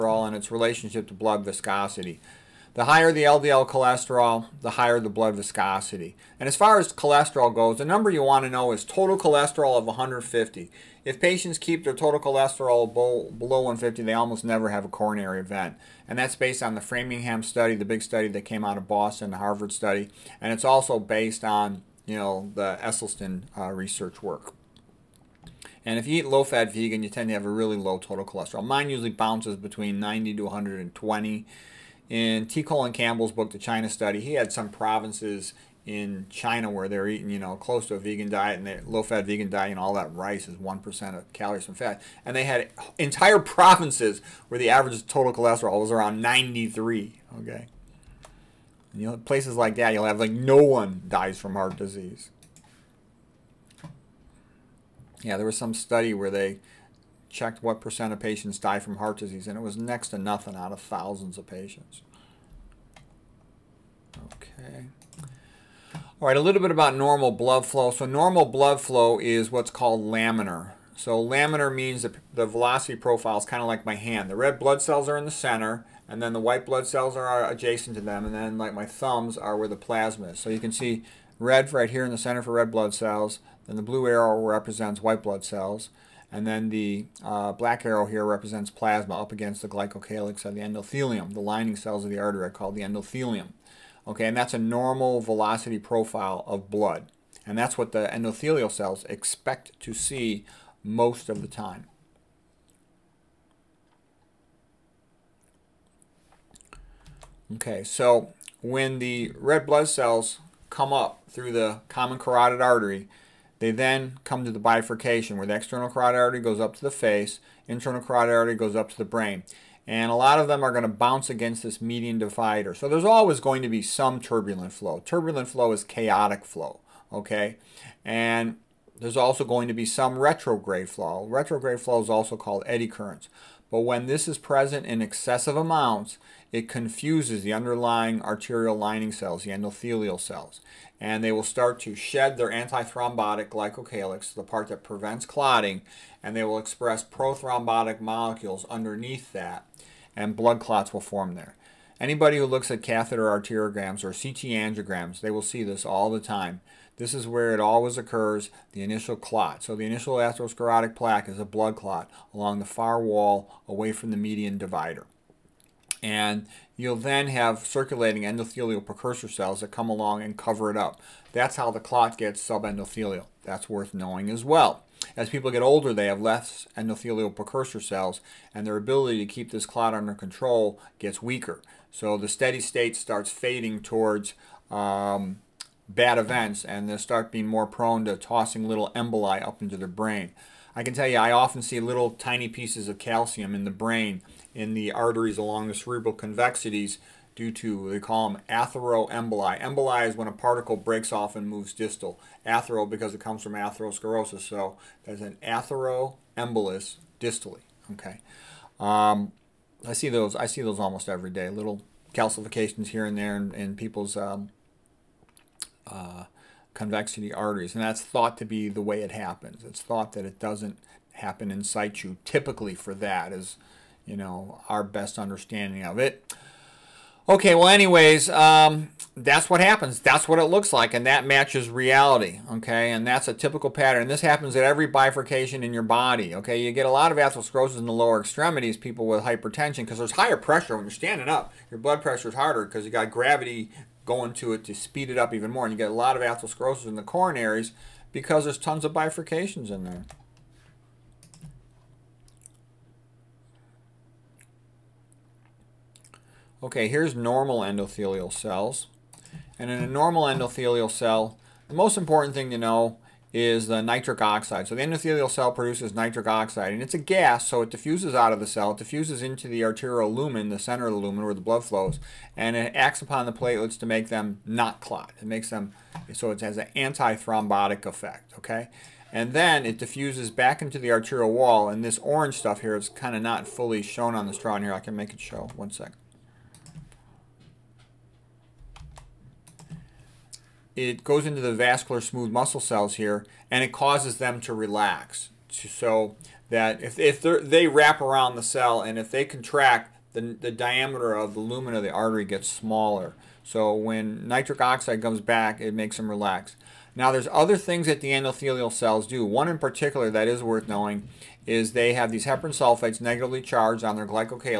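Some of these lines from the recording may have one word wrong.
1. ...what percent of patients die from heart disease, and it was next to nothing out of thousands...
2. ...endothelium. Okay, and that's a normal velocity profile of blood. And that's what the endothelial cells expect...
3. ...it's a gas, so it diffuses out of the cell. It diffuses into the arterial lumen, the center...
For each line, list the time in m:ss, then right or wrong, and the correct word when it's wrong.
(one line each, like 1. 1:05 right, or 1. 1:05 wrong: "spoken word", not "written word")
1. 0:57 right
2. 1:32 right
3. 4:26 right.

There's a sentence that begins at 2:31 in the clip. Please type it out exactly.
Anybody who looks at catheter arteriograms or CT angiograms, they will see this all the time.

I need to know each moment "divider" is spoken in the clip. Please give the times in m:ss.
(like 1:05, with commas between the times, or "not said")
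2:02, 2:44.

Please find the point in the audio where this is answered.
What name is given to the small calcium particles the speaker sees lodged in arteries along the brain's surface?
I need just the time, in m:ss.
3:18.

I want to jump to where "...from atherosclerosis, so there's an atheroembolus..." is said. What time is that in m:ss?
3:23.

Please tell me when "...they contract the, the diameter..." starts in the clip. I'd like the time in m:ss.
4:59.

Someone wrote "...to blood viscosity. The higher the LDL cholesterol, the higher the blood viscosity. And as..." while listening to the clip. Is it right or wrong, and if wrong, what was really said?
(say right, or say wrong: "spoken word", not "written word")
right.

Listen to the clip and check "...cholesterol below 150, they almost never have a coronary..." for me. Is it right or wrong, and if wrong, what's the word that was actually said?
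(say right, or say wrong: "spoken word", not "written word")
right.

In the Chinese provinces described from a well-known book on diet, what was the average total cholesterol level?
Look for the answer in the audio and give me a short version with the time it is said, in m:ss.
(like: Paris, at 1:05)
93, at 0:45.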